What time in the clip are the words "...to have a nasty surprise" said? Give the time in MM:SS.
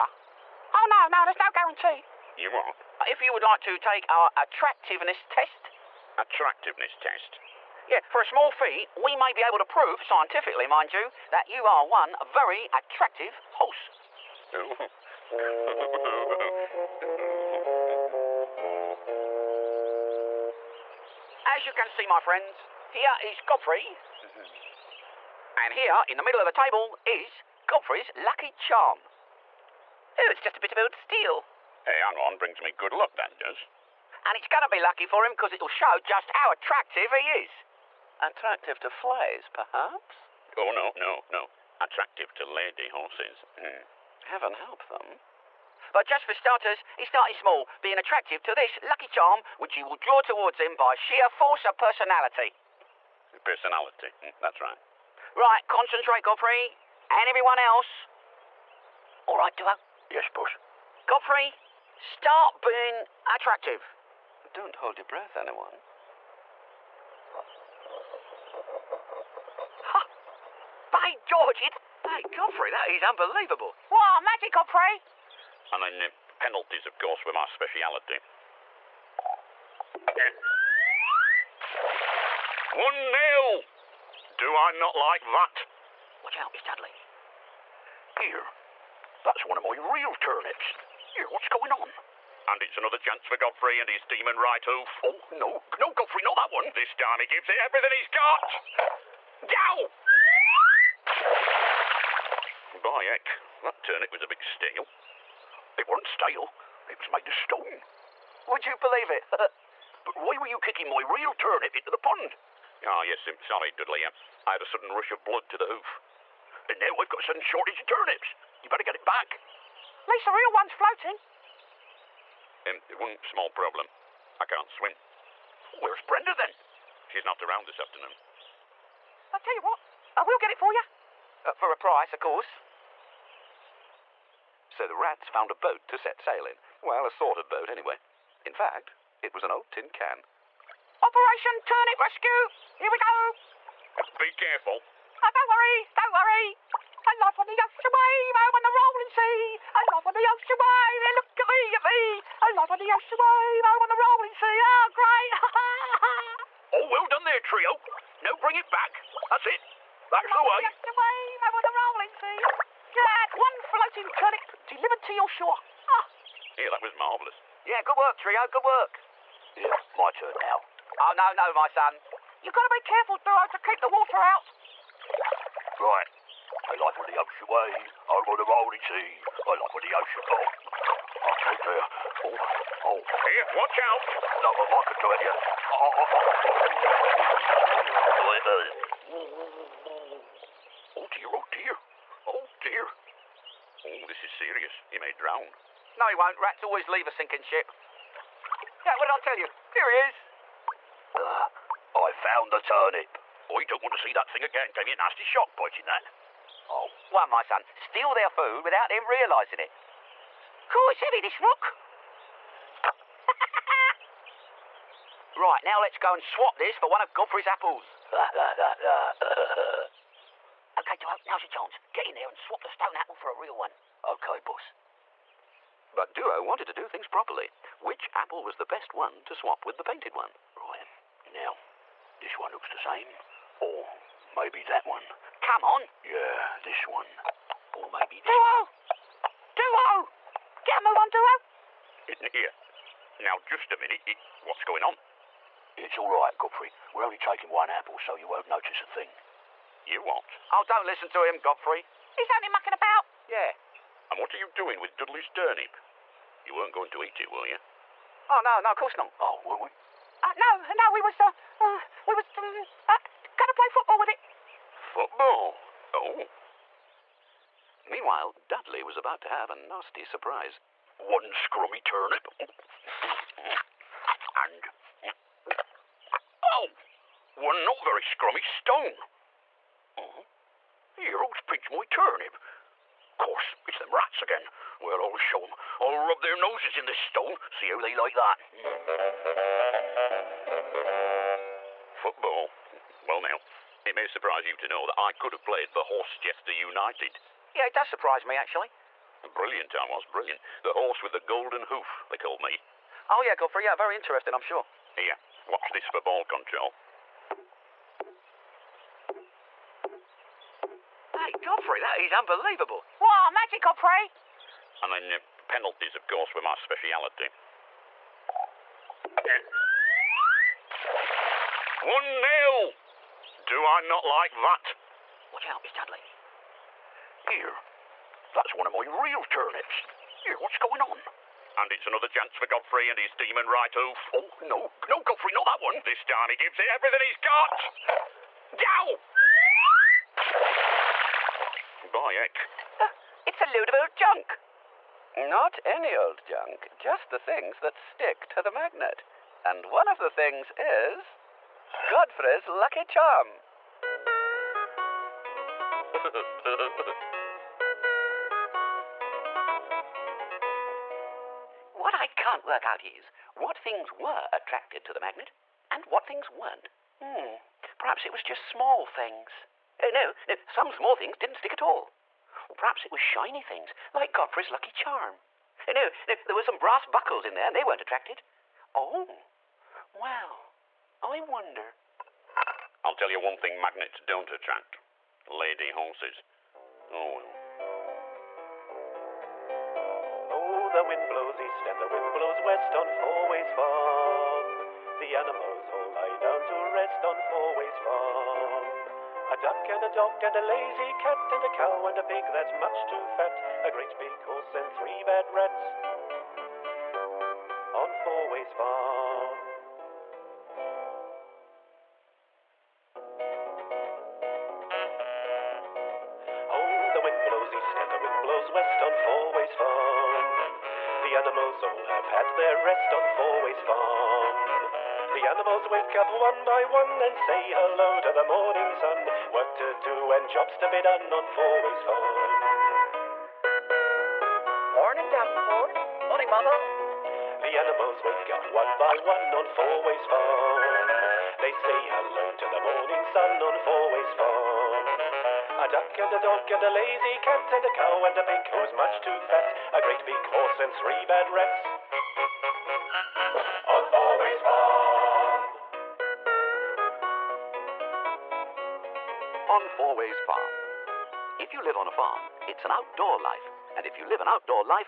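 04:29.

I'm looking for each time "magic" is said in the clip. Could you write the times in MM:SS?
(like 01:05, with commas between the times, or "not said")
01:14, 05:13.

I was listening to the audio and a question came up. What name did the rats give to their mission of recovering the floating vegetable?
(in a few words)
Operation Turnip Rescue.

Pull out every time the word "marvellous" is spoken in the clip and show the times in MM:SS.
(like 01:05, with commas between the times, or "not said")
02:46.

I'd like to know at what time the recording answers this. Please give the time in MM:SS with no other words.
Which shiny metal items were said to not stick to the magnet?
06:16.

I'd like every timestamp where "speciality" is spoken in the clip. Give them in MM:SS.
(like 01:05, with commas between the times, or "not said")
01:17, 05:16.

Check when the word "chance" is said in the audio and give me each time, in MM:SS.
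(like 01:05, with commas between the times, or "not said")
01:32, 03:41, 05:32.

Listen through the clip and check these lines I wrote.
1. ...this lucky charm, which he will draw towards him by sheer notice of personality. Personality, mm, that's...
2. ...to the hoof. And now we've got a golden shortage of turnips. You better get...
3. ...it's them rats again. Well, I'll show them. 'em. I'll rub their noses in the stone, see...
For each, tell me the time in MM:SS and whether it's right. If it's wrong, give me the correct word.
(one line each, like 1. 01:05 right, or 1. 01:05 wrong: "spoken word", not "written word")
1. 00:48 wrong: "force", not "notice"
2. 01:55 wrong: "sudden", not "golden"
3. 04:43 right.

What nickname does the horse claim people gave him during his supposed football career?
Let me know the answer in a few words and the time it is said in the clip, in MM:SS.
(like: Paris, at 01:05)
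The horse with the golden hoof, at 05:00.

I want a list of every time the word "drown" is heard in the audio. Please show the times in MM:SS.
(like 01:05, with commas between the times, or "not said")
03:15.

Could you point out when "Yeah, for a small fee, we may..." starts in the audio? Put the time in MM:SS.
00:07.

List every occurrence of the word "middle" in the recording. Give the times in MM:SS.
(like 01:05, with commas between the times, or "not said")
00:26.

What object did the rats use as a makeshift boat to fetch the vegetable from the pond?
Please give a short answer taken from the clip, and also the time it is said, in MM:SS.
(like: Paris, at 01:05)
An old tin can, at 02:19.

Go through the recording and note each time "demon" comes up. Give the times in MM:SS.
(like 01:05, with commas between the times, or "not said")
01:34, 05:33.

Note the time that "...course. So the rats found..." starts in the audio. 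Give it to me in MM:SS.
02:12.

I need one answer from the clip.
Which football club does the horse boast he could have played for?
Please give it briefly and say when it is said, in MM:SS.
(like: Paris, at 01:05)
Horsechester United, at 04:55.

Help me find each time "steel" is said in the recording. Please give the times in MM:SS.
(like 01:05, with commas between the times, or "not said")
00:30, 01:46.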